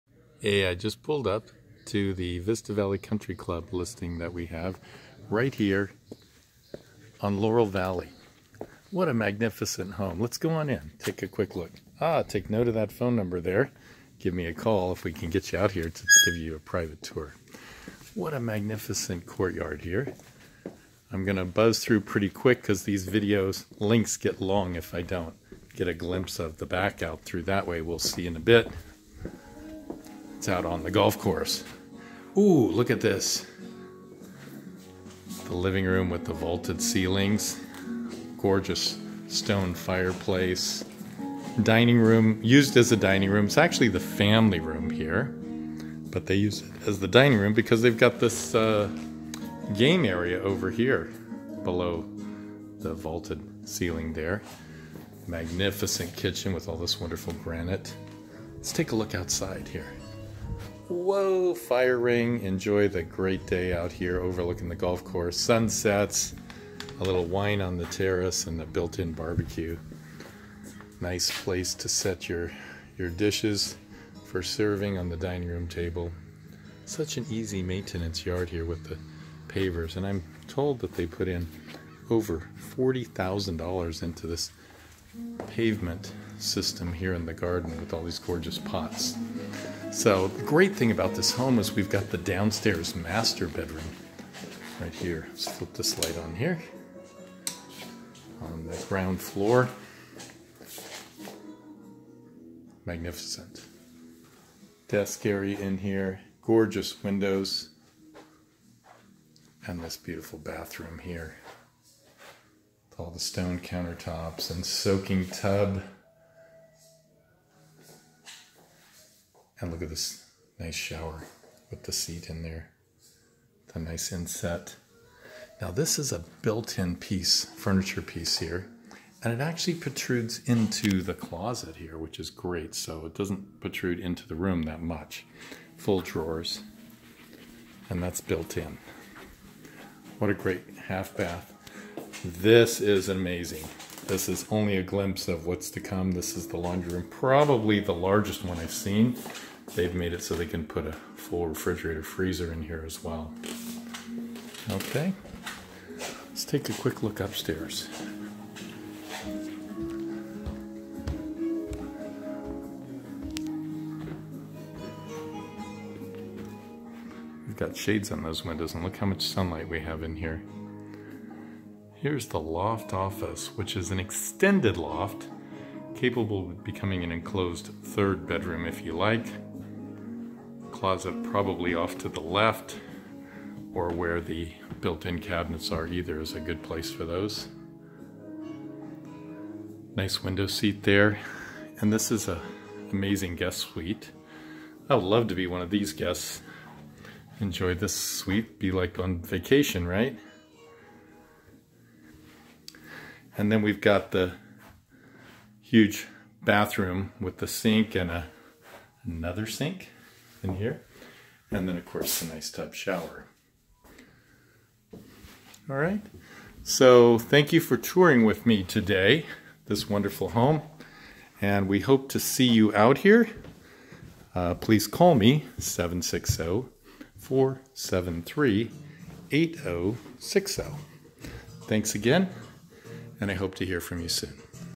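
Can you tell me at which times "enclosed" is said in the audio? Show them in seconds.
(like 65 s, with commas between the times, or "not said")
177 s.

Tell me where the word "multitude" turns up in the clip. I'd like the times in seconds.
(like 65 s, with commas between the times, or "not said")
not said.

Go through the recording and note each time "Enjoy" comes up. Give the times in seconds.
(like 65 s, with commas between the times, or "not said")
62 s, 197 s.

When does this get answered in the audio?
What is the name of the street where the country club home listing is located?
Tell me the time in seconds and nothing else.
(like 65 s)
7 s.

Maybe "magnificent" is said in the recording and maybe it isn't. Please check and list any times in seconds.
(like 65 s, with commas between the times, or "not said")
9 s, 18 s, 55 s, 102 s.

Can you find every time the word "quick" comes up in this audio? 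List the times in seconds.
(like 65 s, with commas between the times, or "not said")
11 s, 22 s, 156 s.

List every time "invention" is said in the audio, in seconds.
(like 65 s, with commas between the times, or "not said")
not said.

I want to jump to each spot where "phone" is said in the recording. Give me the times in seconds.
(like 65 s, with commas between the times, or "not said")
12 s.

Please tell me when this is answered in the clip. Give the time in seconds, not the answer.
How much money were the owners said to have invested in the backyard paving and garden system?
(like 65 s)
82 s.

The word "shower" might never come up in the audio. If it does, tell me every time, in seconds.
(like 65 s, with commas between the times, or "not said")
120 s, 212 s.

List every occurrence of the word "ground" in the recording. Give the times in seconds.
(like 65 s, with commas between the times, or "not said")
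98 s.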